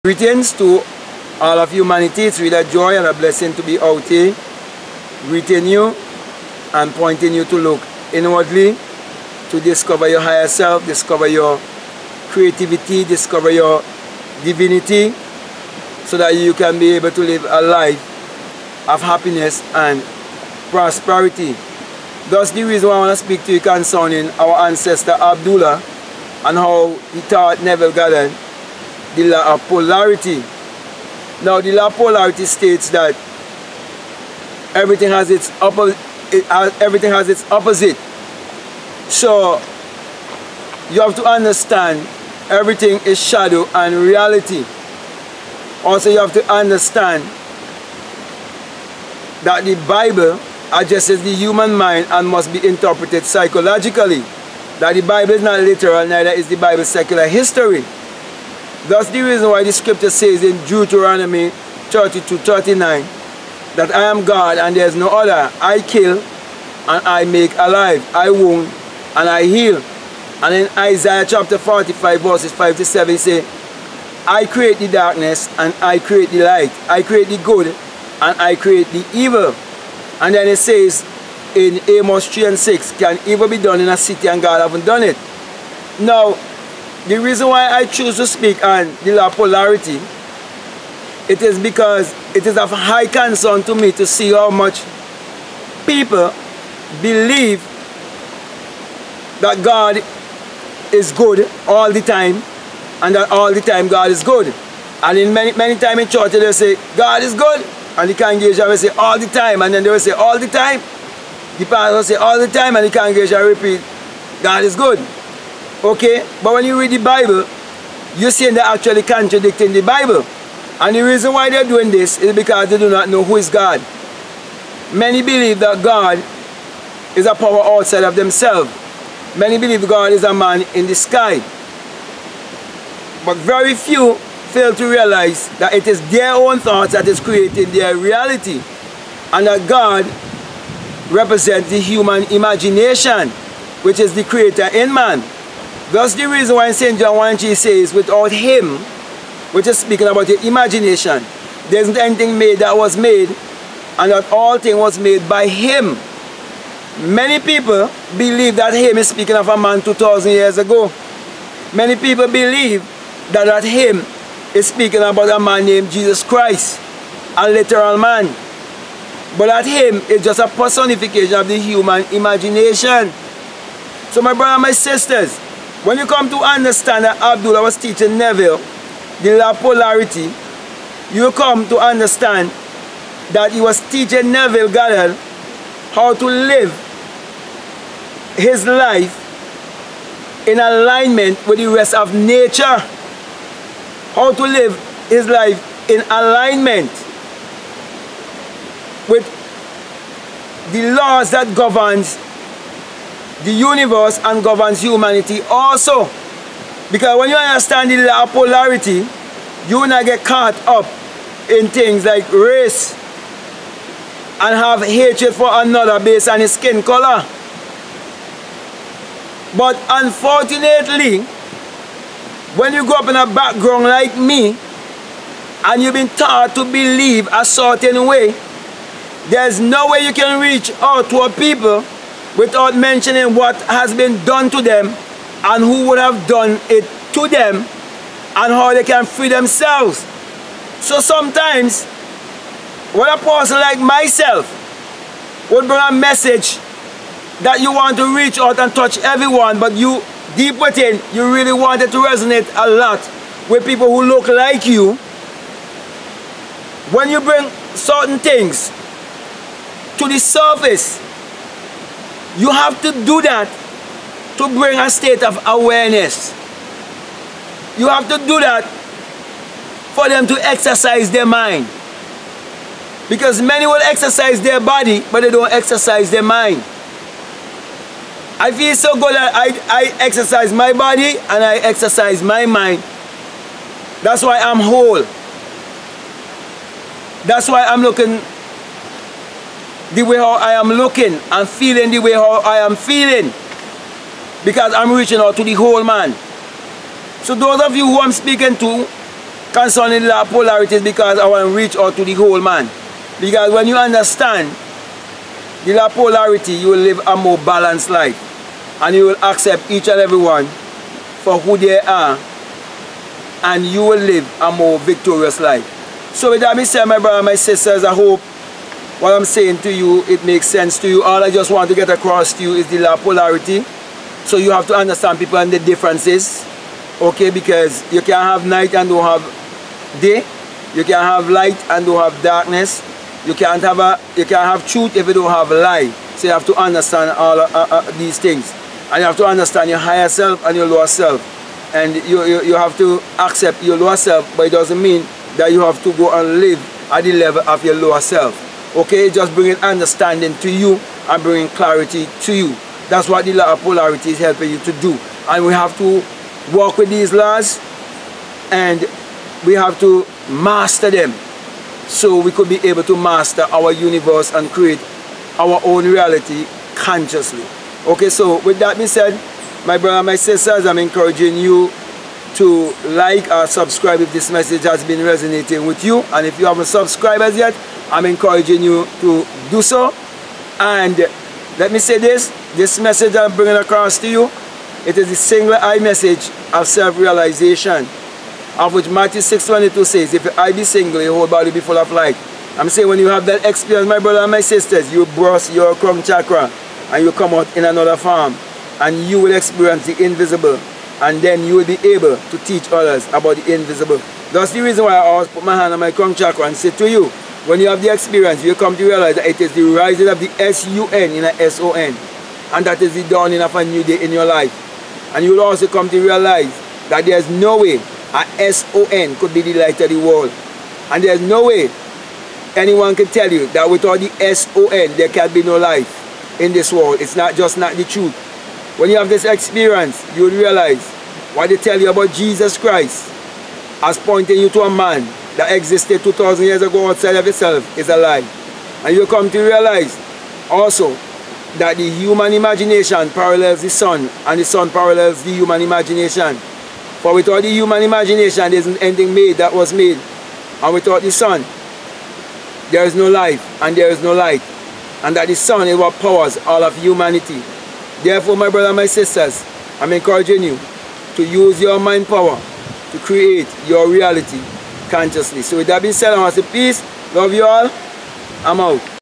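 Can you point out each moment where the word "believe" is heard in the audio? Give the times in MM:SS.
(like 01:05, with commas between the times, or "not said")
01:37, 02:05, 02:09, 02:38, 02:42, 03:46.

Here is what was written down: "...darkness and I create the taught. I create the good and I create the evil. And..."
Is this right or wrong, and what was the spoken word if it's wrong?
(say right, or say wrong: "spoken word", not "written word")
wrong: "light", not "taught".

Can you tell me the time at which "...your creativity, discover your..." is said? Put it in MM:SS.
00:11.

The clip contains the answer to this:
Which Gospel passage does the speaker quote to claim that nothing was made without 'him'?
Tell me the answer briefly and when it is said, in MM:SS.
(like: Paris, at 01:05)
St. John 1, at 02:26.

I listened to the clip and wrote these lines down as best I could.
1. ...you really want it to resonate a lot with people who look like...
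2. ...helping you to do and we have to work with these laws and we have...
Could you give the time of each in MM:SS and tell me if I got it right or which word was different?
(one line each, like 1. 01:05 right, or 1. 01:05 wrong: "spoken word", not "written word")
1. 04:11 right
2. 05:54 right.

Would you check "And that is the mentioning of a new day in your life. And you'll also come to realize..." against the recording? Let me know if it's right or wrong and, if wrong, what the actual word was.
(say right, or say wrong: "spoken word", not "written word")
wrong: "dawning", not "mentioning".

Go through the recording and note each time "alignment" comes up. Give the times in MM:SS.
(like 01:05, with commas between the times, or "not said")
03:10, 03:16.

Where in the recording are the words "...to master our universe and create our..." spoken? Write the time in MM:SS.
06:02.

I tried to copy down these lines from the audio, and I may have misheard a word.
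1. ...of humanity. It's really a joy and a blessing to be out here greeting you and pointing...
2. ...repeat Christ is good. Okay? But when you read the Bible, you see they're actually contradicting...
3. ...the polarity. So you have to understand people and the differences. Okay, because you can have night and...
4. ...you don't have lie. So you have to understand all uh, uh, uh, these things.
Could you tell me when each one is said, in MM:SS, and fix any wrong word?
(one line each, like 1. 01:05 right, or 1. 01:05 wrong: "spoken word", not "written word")
1. 00:01 right
2. 01:53 wrong: "God", not "Christ"
3. 05:22 right
4. 05:35 right.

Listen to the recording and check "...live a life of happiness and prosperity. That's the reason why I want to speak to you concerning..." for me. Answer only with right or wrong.
right.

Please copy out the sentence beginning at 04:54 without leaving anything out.
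Because I'm reaching out to the whole man.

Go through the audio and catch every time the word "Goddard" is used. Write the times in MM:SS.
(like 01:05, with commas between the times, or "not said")
00:27, 03:04.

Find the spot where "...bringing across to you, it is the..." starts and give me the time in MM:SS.
06:23.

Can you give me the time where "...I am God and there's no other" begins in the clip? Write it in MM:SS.
01:03.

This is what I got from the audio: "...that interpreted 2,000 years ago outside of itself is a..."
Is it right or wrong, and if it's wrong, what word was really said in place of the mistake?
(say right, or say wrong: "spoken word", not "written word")
wrong: "existed", not "interpreted".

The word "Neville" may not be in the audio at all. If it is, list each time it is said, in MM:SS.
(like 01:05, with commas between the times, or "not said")
00:27, 02:58, 03:04.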